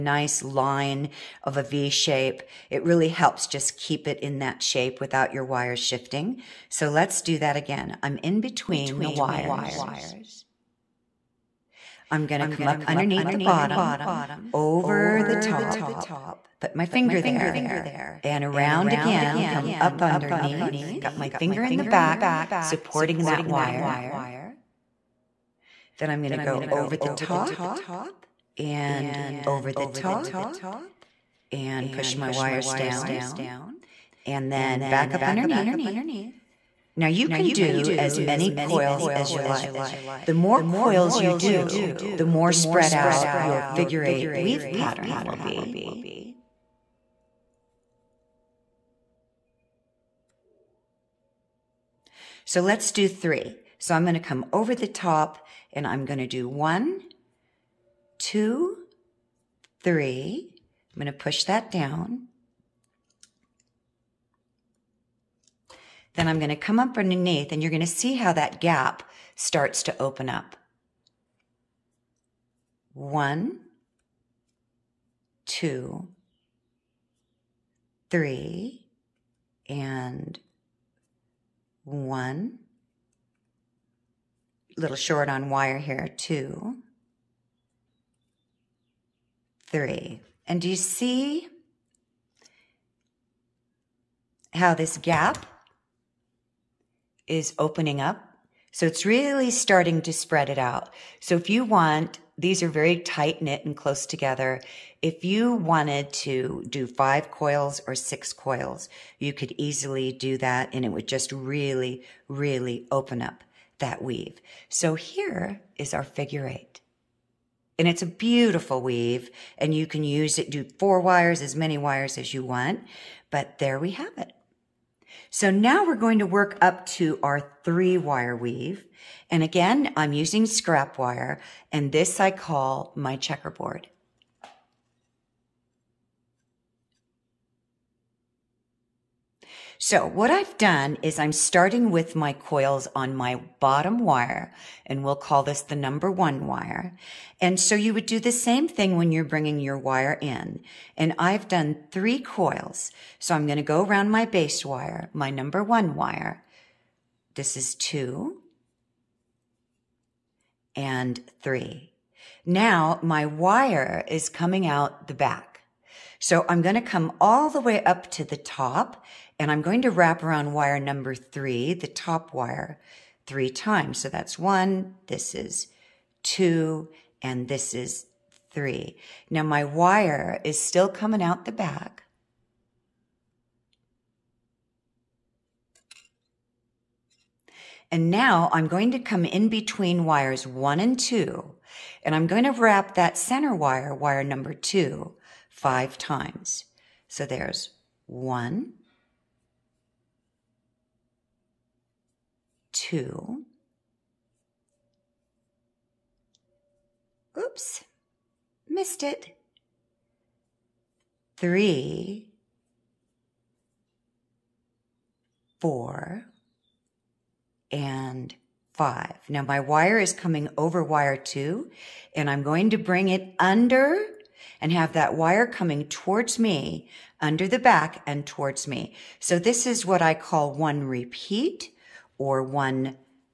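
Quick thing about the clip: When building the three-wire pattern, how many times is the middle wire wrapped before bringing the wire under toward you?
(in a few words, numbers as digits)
5.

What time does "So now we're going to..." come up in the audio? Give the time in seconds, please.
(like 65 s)
125 s.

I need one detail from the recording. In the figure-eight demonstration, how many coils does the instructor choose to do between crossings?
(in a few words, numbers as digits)
3.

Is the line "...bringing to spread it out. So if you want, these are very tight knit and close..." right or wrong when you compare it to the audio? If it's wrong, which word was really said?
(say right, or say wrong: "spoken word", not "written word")
wrong: "starting", not "bringing".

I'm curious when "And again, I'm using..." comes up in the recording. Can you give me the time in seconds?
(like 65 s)
129 s.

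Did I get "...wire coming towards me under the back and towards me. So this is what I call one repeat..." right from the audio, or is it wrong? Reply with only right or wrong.
right.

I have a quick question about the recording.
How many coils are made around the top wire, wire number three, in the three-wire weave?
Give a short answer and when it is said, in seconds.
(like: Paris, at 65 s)
3, at 173 s.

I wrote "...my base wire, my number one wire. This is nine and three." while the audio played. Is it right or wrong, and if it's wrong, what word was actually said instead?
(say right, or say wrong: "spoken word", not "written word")
wrong: "two", not "nine".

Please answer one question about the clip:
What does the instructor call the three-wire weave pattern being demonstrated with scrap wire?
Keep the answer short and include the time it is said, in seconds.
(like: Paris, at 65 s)
checkerboard, at 133 s.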